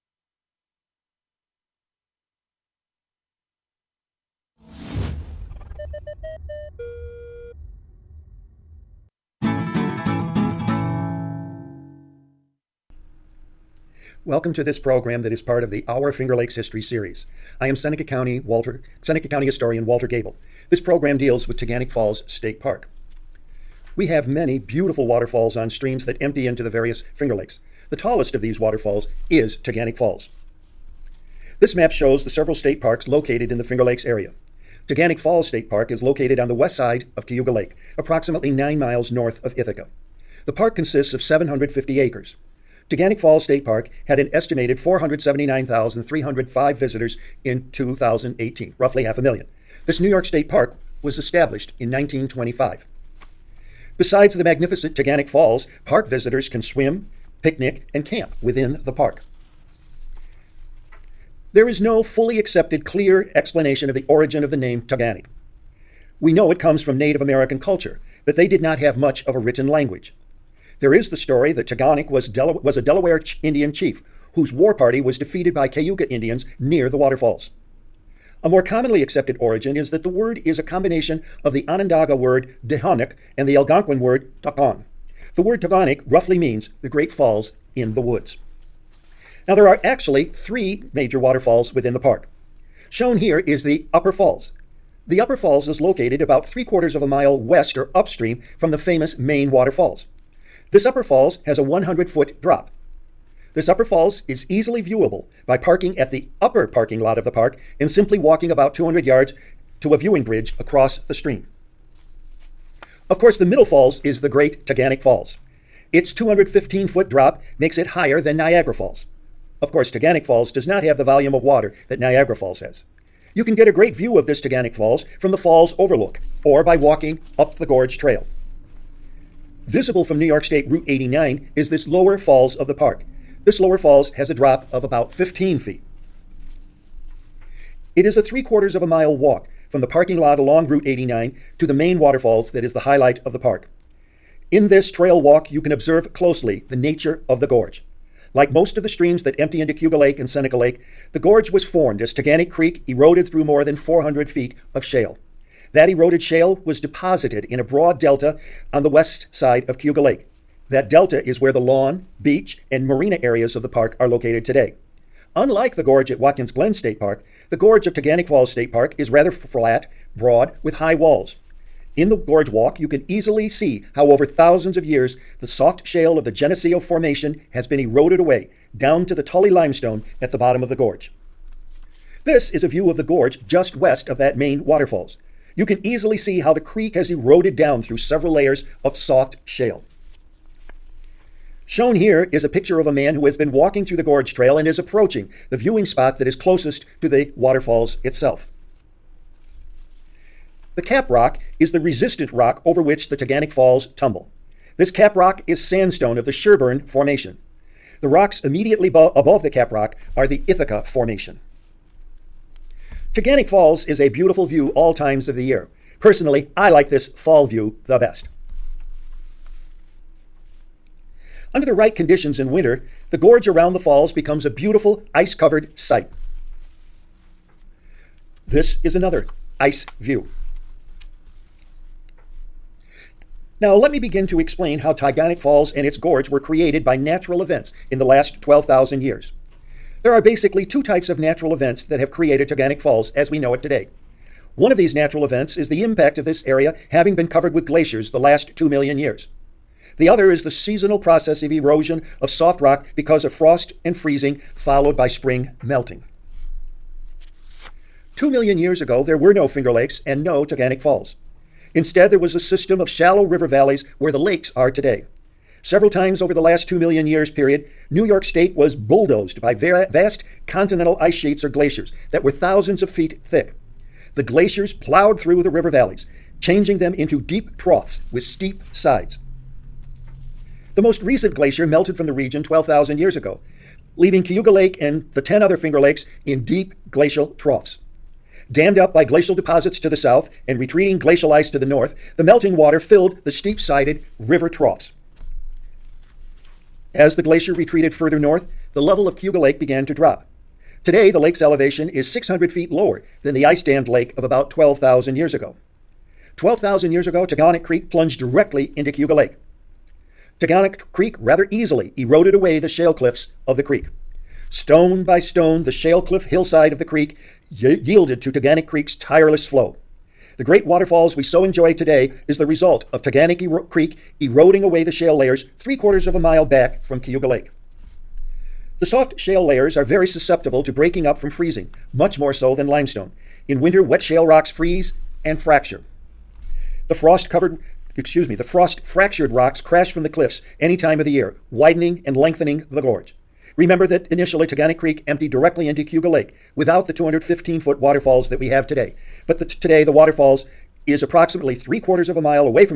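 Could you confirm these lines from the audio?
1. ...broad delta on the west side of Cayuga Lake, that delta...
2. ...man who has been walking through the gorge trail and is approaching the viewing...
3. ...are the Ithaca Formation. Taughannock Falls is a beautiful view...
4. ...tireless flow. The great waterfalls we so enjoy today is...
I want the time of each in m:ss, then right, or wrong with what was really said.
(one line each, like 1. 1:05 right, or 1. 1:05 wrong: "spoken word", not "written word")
1. 2:37 right
2. 3:12 right
3. 3:30 right
4. 5:18 right.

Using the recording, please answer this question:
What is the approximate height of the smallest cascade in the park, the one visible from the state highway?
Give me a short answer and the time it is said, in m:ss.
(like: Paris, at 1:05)
15 feet, at 2:15.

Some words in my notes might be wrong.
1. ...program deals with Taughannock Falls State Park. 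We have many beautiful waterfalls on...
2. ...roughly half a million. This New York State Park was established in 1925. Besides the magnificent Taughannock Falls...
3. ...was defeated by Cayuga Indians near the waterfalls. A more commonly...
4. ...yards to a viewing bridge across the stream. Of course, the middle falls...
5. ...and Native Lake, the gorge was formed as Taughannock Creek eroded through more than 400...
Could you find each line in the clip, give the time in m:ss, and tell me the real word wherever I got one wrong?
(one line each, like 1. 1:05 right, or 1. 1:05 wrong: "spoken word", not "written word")
1. 0:20 right
2. 0:48 right
3. 1:14 right
4. 1:49 right
5. 2:30 wrong: "Seneca", not "Native".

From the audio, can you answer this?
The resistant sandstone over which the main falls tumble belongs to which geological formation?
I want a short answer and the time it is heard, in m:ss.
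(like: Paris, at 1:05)
Sherburne Formation, at 3:26.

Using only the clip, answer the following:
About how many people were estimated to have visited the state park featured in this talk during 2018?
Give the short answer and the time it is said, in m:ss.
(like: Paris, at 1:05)
479,305, at 0:44.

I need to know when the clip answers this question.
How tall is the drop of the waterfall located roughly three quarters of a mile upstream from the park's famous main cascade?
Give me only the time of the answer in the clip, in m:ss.
1:41.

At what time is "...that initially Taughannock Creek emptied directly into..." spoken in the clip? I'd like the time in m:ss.
5:43.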